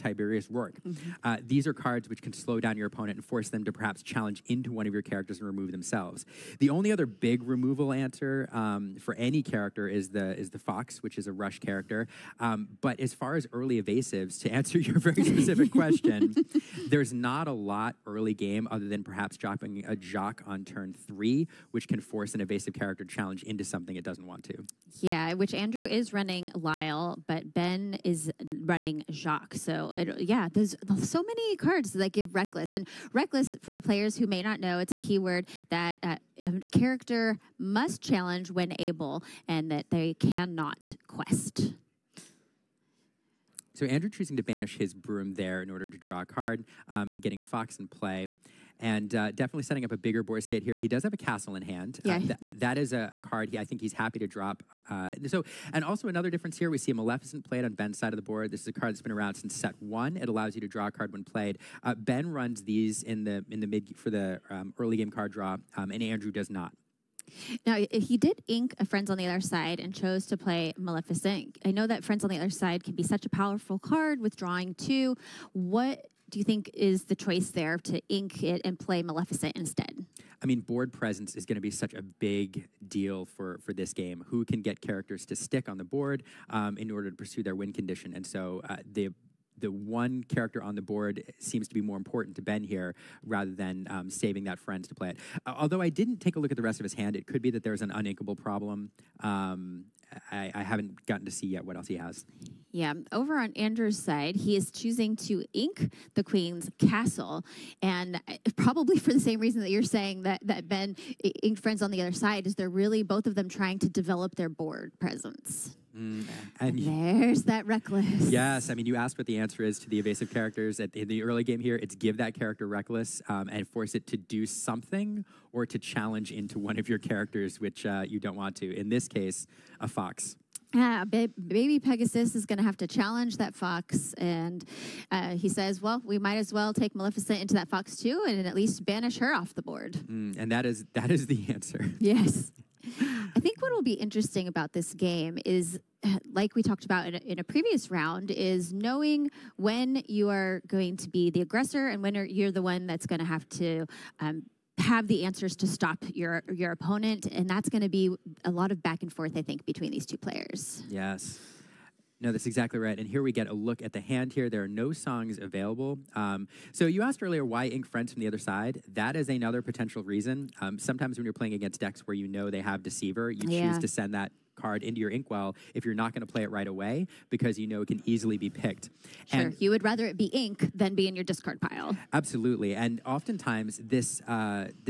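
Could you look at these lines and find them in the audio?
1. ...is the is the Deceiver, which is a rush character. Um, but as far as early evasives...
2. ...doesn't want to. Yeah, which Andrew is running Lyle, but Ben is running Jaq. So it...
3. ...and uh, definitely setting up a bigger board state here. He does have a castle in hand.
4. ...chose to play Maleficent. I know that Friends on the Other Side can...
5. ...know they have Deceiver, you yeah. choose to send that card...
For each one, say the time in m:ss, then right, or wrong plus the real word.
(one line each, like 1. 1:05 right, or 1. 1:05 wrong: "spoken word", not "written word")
1. 0:09 wrong: "Fox", not "Deceiver"
2. 0:24 right
3. 0:48 right
4. 1:09 right
5. 2:52 right.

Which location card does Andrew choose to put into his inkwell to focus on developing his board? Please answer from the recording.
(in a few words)
Queen's castle.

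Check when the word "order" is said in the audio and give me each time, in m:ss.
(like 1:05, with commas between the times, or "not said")
0:45, 1:26.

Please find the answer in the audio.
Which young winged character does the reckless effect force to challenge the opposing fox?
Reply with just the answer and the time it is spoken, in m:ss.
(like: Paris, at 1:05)
Baby Pegasus, at 2:11.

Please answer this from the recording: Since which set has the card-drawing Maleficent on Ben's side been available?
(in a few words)
Set one.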